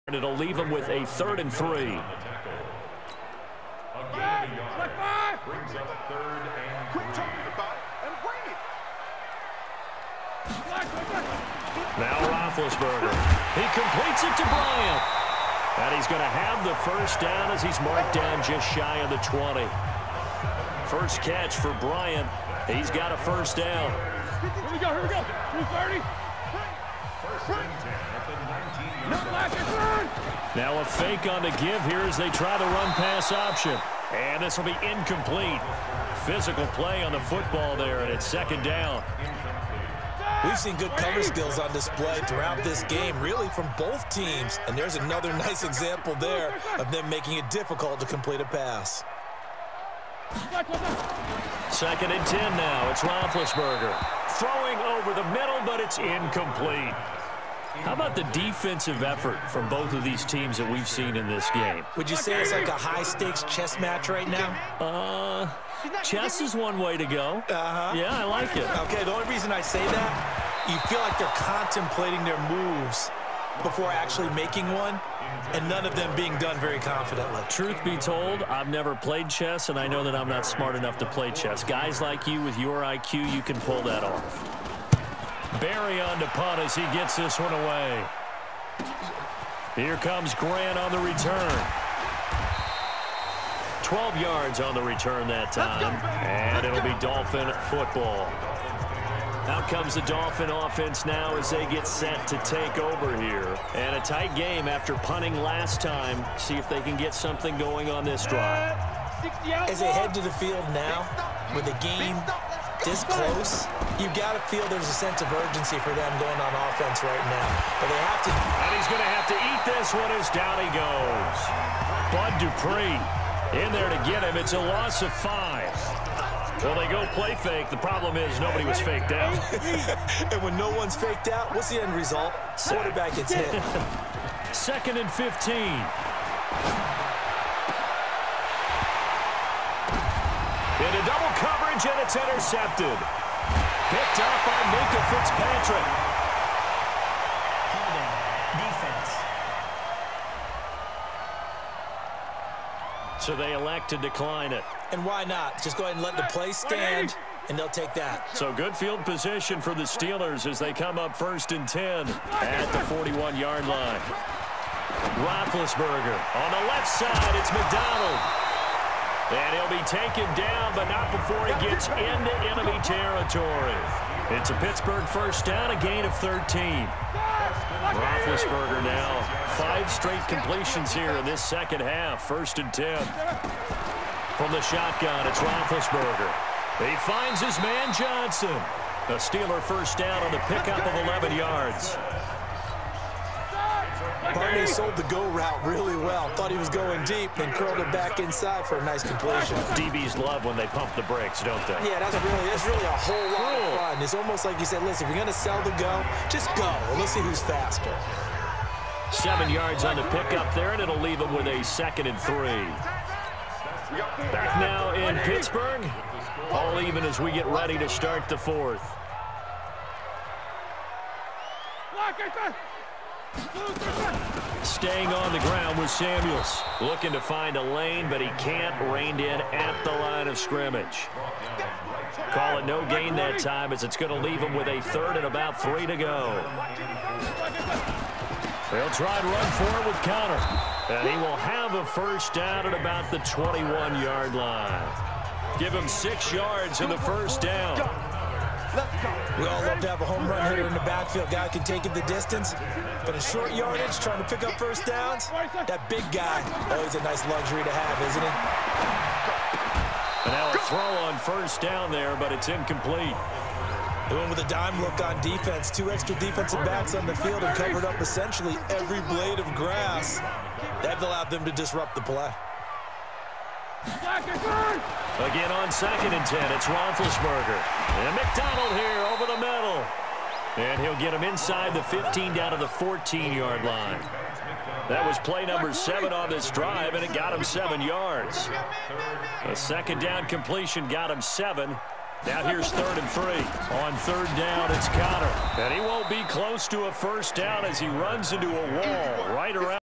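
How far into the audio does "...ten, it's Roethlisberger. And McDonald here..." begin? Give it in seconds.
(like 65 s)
276 s.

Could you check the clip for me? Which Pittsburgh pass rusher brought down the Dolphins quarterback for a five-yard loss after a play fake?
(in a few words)
Bud Dupree.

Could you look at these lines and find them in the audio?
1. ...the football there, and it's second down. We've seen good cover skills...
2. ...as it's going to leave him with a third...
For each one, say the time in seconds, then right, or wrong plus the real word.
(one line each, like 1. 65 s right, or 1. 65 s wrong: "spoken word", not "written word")
1. 37 s right
2. 233 s right.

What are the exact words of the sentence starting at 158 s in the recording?
So good field position for the Steelers as they come up first and 10 at the 41-yard line.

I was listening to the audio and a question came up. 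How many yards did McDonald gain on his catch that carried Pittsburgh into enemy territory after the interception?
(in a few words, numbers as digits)
13.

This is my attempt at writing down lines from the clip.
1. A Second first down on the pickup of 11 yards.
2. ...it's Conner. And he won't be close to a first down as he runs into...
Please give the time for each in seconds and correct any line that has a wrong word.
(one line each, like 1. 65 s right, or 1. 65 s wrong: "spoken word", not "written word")
1. 189 s wrong: "Steeler", not "Second"
2. 294 s right.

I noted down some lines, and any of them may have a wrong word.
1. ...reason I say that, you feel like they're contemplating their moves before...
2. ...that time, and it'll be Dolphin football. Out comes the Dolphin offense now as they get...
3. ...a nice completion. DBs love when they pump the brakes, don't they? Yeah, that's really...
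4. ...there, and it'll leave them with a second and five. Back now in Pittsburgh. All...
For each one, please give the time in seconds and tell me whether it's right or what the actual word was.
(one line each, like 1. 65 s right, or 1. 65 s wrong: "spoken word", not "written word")
1. 69 s right
2. 95 s right
3. 198 s right
4. 210 s wrong: "three", not "five".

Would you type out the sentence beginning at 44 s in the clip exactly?
And there's another nice example there of them making it difficult to complete a pass.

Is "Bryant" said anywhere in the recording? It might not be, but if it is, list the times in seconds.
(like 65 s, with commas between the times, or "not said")
14 s, 21 s.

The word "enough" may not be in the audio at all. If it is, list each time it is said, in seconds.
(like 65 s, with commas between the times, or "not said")
80 s.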